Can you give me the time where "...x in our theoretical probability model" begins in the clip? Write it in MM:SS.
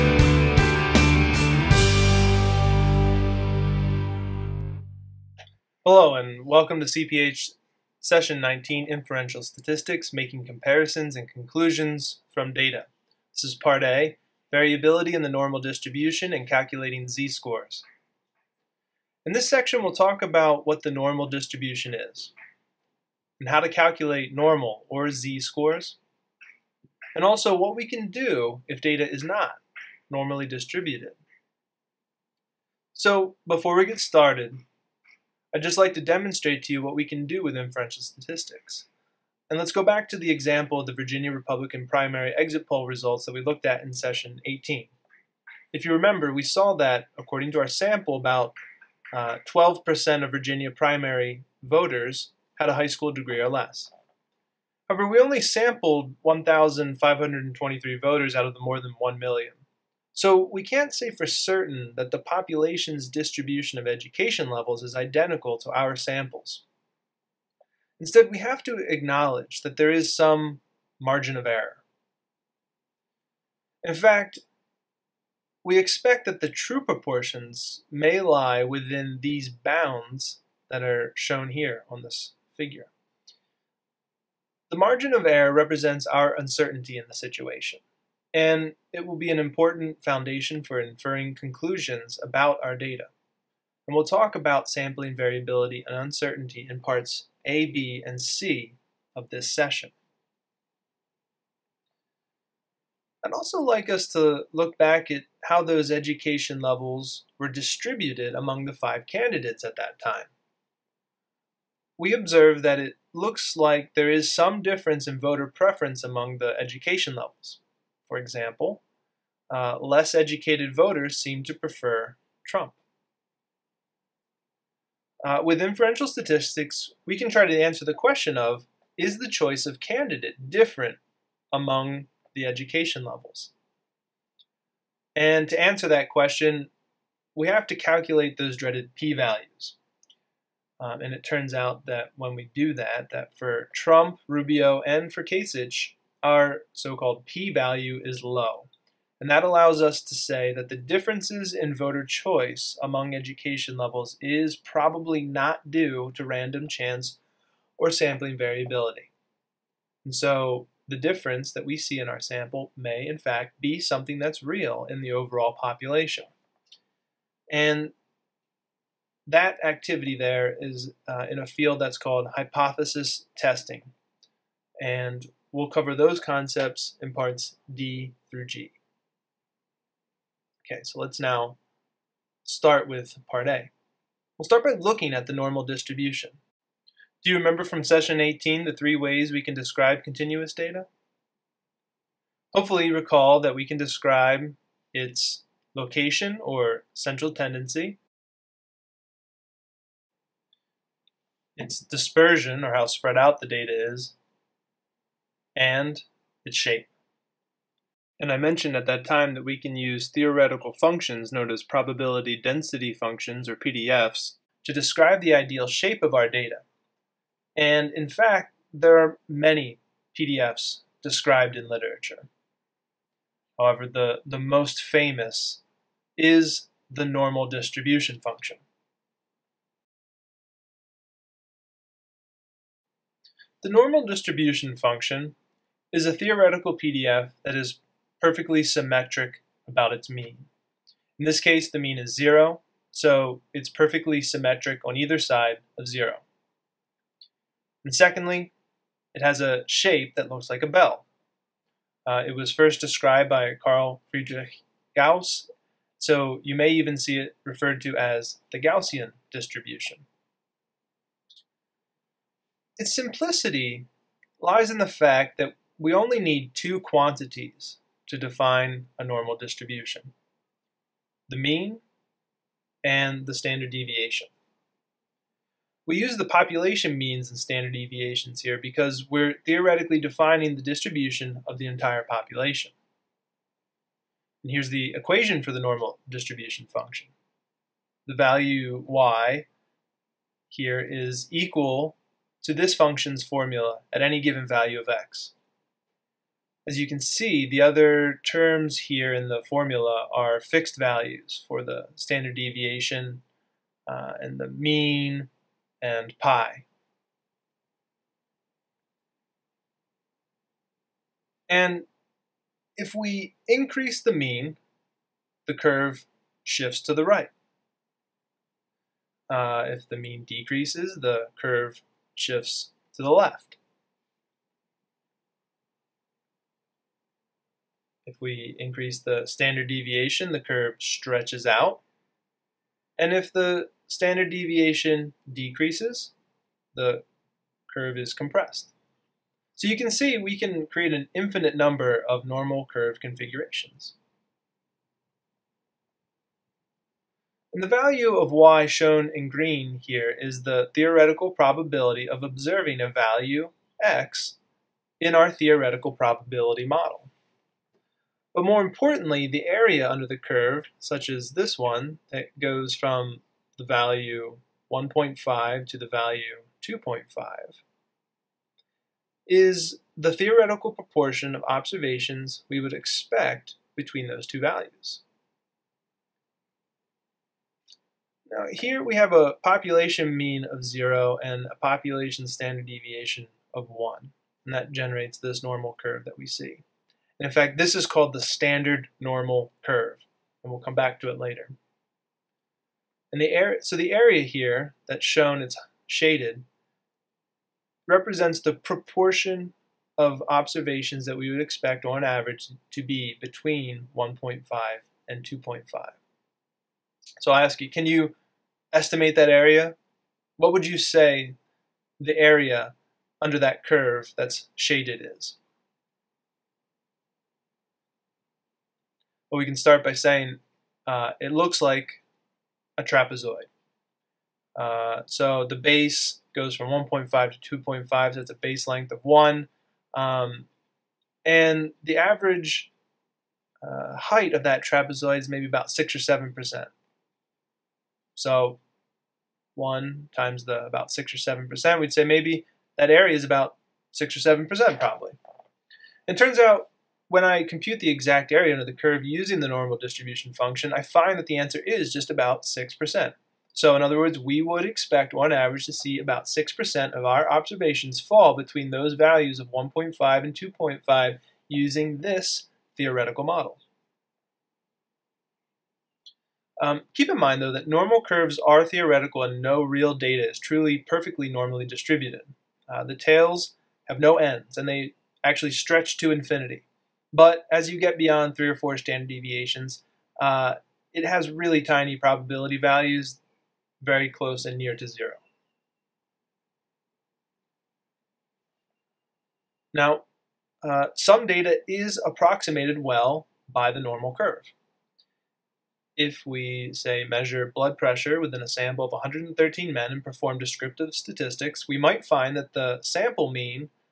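05:53.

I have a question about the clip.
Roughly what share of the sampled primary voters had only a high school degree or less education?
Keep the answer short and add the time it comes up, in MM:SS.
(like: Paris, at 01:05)
12%, at 00:49.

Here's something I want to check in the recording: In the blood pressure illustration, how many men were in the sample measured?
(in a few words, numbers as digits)
113.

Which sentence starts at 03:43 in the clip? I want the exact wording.
However, the, the most famous is the normal distribution function.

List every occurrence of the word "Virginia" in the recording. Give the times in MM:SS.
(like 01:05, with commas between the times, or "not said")
00:40, 00:50.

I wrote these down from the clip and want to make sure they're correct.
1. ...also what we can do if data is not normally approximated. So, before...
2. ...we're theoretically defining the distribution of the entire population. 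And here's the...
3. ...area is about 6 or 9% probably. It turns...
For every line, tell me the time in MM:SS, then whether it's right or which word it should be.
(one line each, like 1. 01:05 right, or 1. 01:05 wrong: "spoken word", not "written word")
1. 00:27 wrong: "distributed", not "approximated"
2. 04:39 right
3. 07:22 wrong: "7", not "9".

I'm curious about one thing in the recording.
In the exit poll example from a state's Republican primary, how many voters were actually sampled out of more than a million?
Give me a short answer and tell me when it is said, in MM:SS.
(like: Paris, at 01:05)
1,523, at 00:56.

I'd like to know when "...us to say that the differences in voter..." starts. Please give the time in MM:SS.
02:29.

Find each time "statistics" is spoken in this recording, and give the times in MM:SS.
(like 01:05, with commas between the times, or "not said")
00:09, 00:38, 02:06, 08:20.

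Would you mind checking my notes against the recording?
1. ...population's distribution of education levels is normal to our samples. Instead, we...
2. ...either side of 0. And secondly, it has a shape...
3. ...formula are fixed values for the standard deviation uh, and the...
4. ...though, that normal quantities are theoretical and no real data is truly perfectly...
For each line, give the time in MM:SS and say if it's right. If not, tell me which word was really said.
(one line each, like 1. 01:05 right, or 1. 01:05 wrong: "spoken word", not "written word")
1. 01:02 wrong: "identical", not "normal"
2. 04:04 right
3. 04:59 right
4. 07:47 wrong: "curves", not "quantities".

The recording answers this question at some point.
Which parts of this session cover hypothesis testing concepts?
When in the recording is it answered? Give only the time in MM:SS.
02:57.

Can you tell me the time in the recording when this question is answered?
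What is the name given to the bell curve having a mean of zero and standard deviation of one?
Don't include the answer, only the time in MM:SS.
06:28.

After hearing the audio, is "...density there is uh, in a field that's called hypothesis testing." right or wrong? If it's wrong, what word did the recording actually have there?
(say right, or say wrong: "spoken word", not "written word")
wrong: "activity", not "density".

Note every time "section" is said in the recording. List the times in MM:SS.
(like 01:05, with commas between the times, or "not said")
00:19.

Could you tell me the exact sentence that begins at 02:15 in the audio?
And to answer that question, we have to calculate those dreaded p-values.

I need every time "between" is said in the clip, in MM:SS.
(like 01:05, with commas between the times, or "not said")
06:13, 06:43, 07:38.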